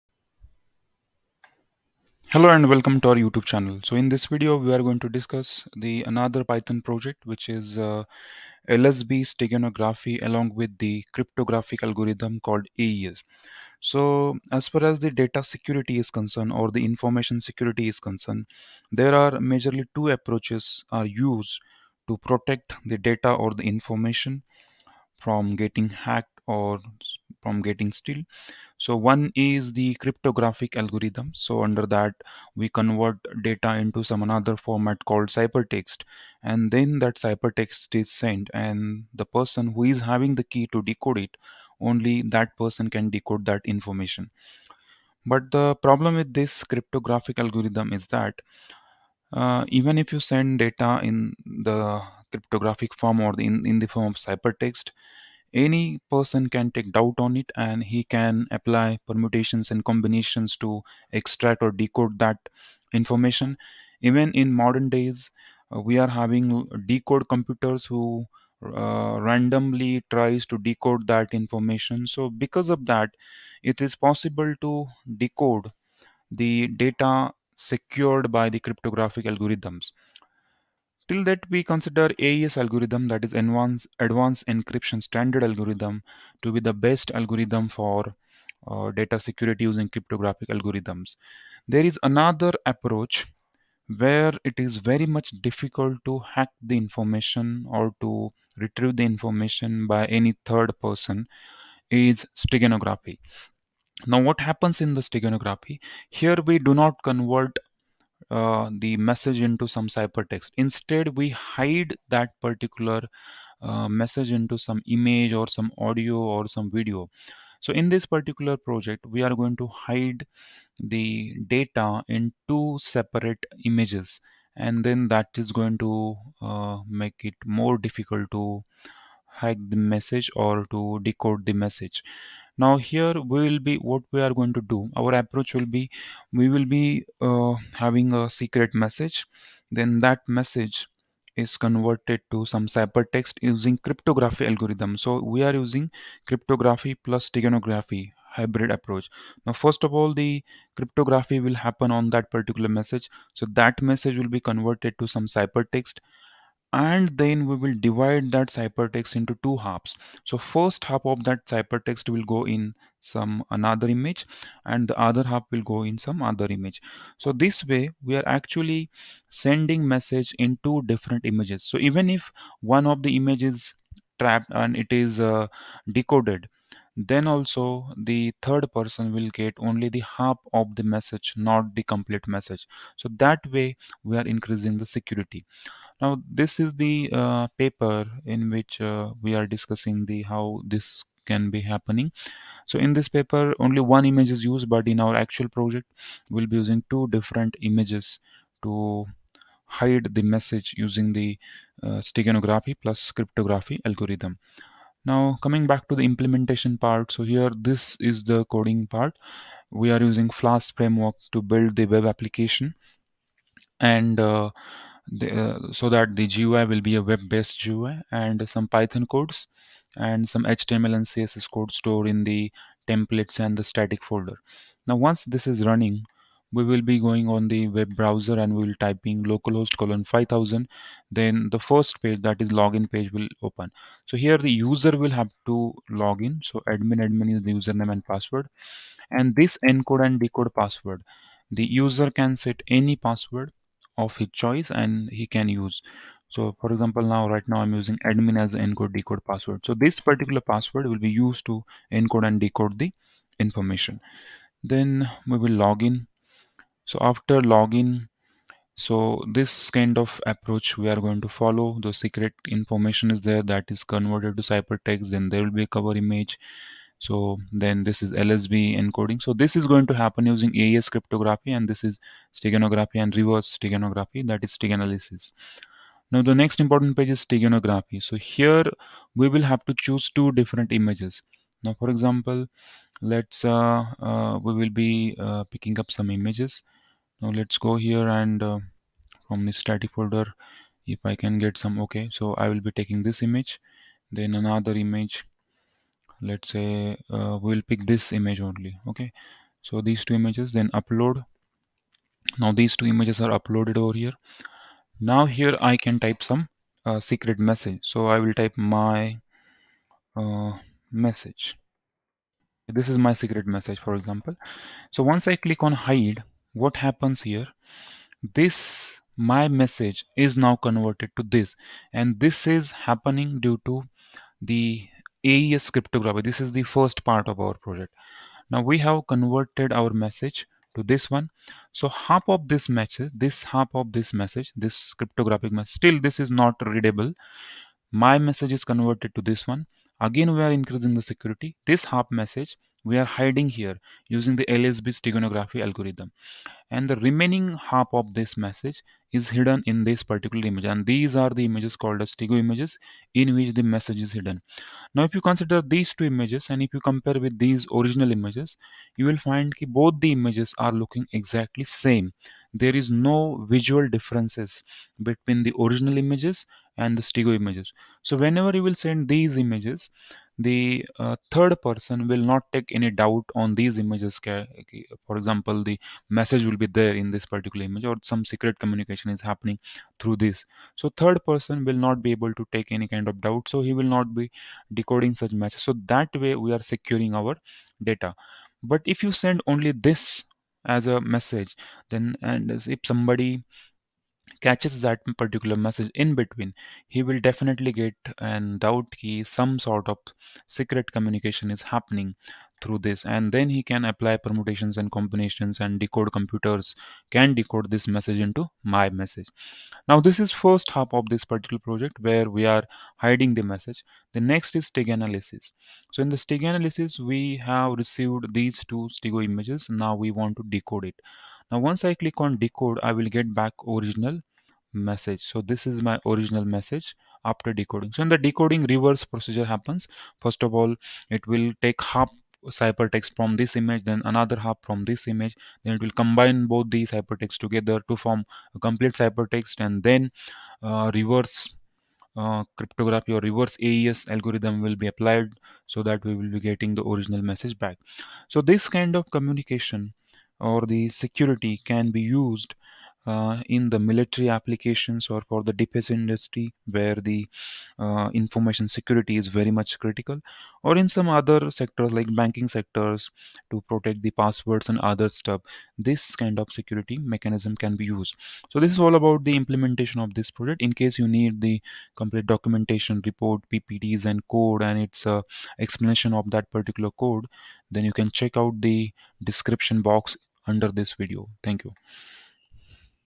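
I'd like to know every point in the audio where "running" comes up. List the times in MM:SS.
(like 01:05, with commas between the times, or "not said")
03:45.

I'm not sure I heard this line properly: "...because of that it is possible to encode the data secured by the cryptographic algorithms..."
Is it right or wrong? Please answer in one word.
wrong.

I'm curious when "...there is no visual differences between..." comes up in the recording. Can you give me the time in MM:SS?
06:02.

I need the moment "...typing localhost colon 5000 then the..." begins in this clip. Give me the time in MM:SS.
03:48.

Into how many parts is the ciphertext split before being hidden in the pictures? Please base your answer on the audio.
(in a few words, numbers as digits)
2.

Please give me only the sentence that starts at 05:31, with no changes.
So half of this message, this half of this message, this cryptographic message, still this is not readable.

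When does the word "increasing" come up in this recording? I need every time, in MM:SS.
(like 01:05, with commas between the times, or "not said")
03:04, 05:40.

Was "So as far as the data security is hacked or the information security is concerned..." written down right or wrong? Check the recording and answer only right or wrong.
wrong.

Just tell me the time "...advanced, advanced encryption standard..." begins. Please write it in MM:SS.
01:23.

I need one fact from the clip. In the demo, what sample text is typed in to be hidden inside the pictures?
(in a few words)
this is my secret message.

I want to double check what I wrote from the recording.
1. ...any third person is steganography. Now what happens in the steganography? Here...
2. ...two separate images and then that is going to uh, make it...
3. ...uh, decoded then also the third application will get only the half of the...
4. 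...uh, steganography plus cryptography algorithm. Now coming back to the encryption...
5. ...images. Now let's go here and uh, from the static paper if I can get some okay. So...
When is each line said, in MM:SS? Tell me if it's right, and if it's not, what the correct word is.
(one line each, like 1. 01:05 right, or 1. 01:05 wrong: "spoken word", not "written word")
1. 01:40 right
2. 02:02 right
3. 02:55 wrong: "person", not "application"
4. 03:21 wrong: "implementation", not "encryption"
5. 04:46 wrong: "folder", not "paper".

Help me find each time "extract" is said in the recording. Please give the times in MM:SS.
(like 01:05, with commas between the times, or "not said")
01:01.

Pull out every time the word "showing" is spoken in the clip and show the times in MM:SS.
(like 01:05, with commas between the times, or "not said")
not said.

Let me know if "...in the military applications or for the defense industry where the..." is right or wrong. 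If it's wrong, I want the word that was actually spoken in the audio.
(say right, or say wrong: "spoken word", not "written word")
right.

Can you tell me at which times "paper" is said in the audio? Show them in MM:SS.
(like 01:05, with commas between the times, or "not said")
03:07, 03:13.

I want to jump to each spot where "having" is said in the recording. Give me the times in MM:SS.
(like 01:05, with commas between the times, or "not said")
00:40, 01:06, 02:17.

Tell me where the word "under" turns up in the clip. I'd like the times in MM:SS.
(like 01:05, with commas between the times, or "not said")
00:31, 08:00.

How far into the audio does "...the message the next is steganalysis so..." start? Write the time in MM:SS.
06:53.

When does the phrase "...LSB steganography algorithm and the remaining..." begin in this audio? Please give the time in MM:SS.
05:44.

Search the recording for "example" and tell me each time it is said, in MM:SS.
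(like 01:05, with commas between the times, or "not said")
04:06, 04:41, 05:13, 06:15.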